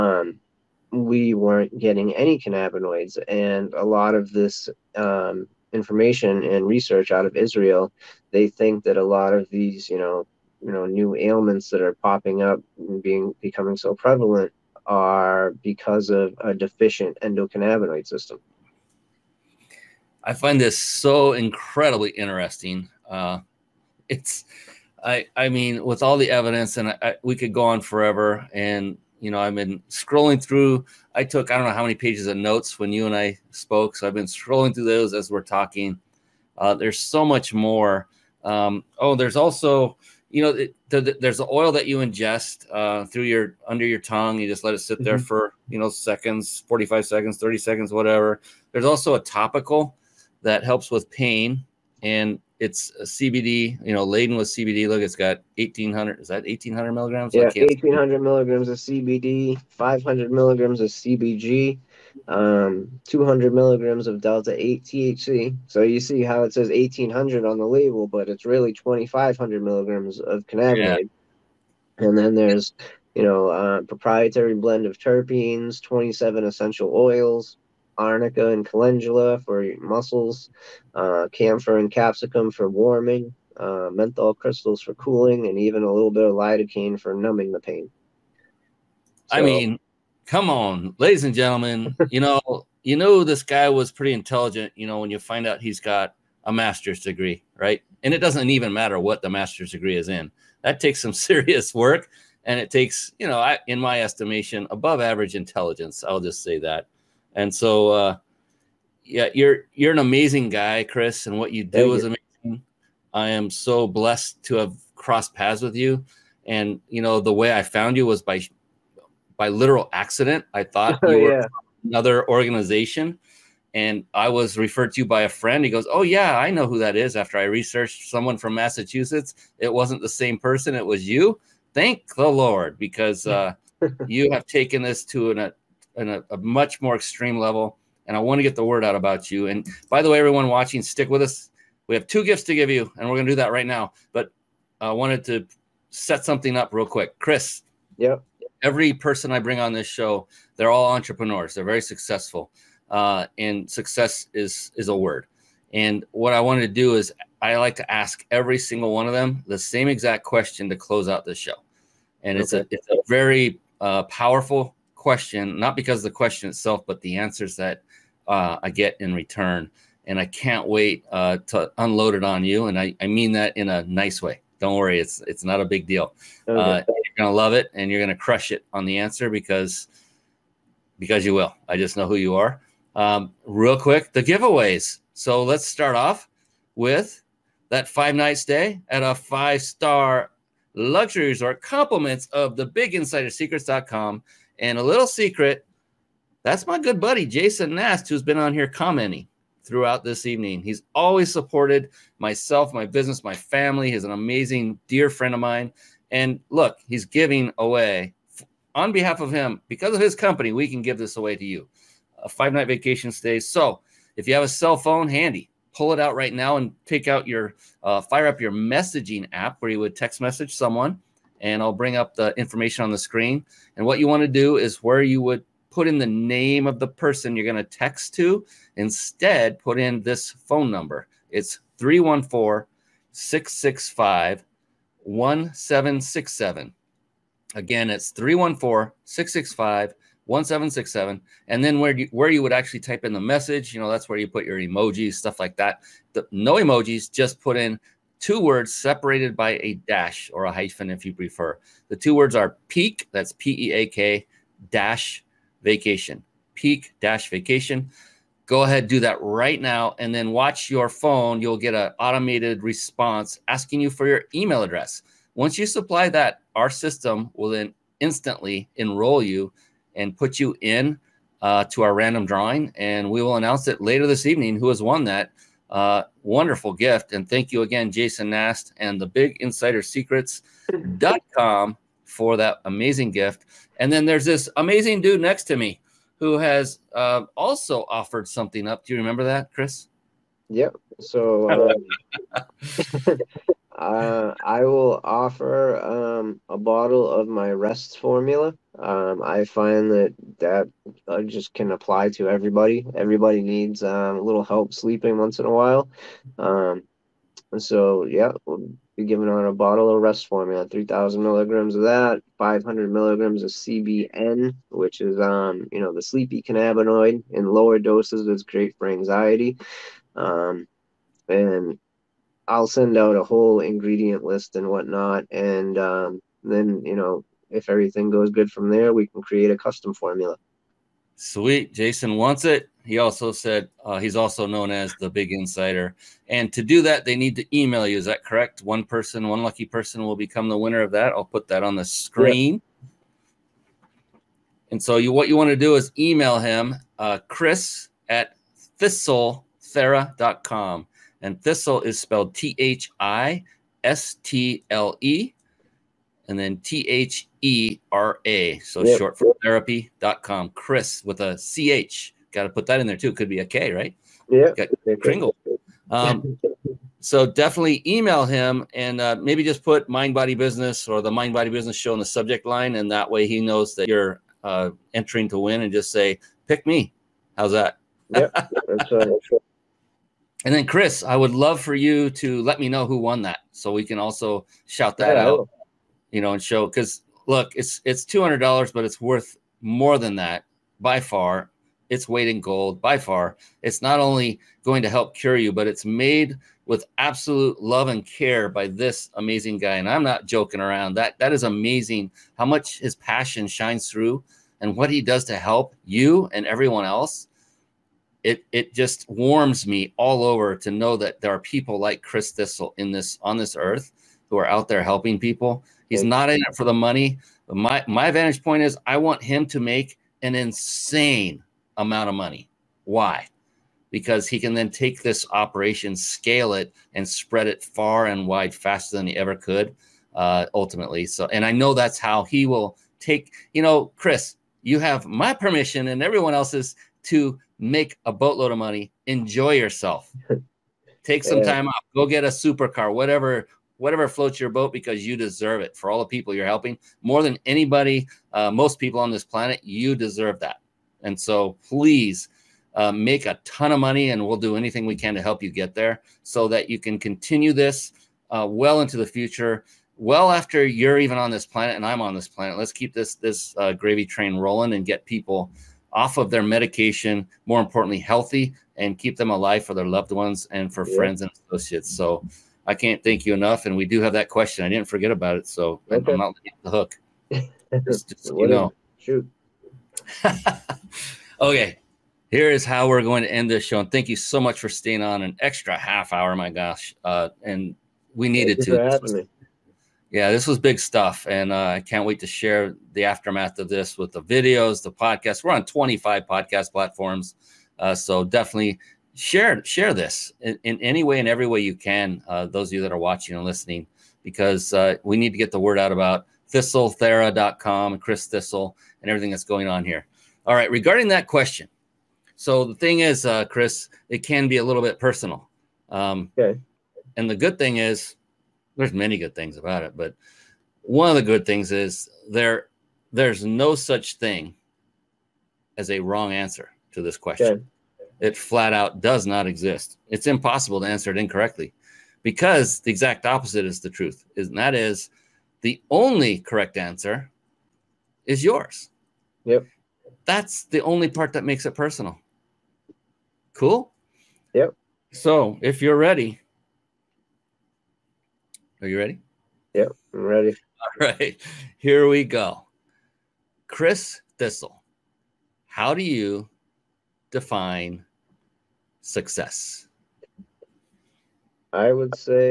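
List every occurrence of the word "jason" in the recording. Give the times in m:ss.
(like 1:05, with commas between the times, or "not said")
3:17, 4:37, 5:31.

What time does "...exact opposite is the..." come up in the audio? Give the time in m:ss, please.
8:52.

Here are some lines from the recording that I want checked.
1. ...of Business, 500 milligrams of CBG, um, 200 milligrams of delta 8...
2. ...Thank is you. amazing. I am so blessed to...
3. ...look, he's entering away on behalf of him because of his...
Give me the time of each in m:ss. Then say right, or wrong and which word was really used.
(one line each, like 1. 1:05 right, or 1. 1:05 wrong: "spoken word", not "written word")
1. 0:58 wrong: "CBD", not "Business"
2. 1:51 right
3. 3:26 wrong: "giving", not "entering".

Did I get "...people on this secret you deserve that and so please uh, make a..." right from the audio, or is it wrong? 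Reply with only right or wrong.
wrong.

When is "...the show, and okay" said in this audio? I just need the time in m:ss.
2:41.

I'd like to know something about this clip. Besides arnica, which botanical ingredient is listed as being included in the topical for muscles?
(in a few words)
calendula.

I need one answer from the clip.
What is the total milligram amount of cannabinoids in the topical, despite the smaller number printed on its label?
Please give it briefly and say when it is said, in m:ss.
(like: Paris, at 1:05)
2500 milligrams, at 1:08.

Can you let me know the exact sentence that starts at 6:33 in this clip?
It's not only going to help cure you, but it's made with absolute love and care by this amazing guy.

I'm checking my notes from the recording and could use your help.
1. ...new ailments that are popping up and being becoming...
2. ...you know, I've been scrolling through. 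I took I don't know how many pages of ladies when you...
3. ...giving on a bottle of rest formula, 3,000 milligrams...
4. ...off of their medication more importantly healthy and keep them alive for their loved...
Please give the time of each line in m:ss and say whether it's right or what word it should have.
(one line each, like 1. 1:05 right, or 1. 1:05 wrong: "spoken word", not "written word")
1. 0:10 right
2. 0:29 wrong: "notes", not "ladies"
3. 5:09 right
4. 7:45 right.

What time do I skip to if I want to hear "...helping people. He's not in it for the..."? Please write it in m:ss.
6:54.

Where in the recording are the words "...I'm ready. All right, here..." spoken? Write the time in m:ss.
9:10.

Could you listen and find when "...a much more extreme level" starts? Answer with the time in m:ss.
2:16.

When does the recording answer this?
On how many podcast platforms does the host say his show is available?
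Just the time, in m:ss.
8:15.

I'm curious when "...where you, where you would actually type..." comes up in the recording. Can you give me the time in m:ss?
4:01.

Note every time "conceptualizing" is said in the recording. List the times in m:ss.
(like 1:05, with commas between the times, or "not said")
not said.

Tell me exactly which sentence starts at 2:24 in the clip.
But I wanted to set something up real quick.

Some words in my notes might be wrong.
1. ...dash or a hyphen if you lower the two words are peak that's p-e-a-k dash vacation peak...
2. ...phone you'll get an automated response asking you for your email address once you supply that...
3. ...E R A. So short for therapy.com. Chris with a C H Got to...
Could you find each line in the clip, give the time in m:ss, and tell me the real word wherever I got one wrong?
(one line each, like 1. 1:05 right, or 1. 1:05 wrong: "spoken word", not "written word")
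1. 4:09 wrong: "prefer", not "lower"
2. 4:20 right
3. 5:57 right.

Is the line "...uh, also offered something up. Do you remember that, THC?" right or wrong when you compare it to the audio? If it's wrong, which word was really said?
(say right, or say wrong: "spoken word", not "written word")
wrong: "Chris", not "THC".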